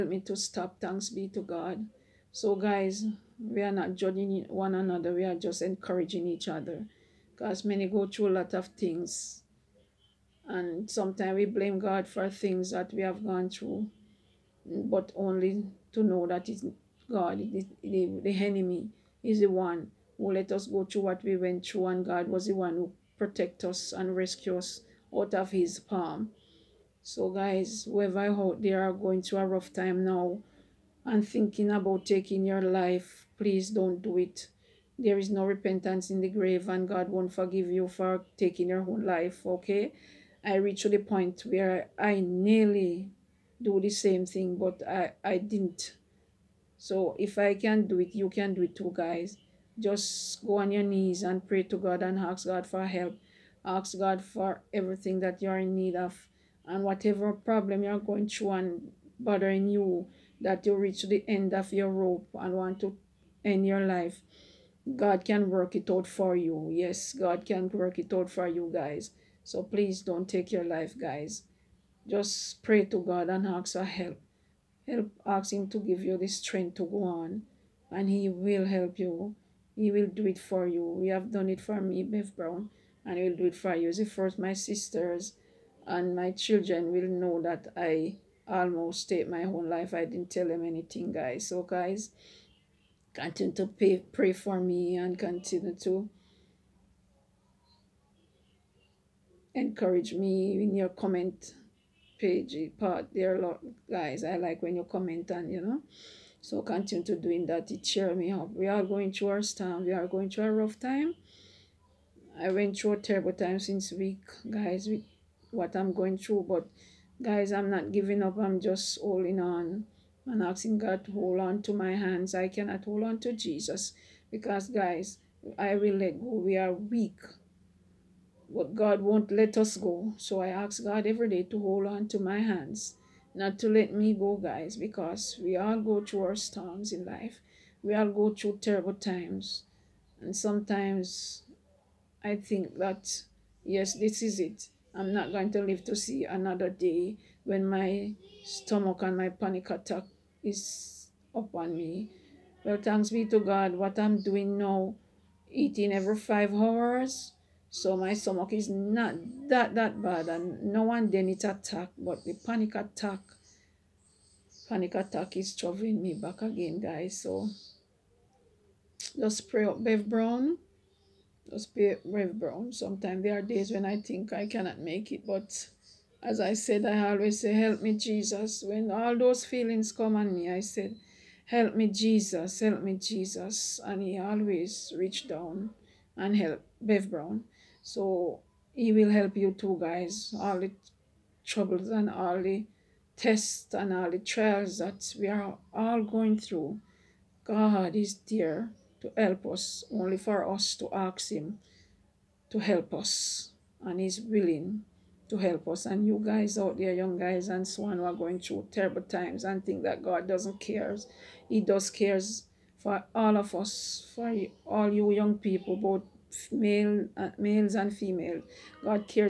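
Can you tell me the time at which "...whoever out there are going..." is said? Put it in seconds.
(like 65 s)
27 s.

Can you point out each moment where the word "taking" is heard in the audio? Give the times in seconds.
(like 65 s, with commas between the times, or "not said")
32 s, 38 s.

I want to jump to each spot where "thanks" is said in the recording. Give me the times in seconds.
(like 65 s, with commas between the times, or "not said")
0 s, 152 s.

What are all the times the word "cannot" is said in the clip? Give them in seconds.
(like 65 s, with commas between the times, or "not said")
122 s, 174 s.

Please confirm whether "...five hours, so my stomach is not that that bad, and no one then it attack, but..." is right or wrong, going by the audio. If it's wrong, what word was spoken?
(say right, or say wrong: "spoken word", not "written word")
right.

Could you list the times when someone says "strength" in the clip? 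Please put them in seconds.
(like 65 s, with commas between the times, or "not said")
76 s.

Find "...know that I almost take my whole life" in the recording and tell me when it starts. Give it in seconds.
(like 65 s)
87 s.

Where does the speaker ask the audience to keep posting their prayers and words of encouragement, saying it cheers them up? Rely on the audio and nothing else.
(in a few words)
comment page.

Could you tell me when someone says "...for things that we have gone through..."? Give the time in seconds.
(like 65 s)
12 s.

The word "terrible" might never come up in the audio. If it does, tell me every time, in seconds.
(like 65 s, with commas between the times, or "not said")
112 s, 138 s, 208 s.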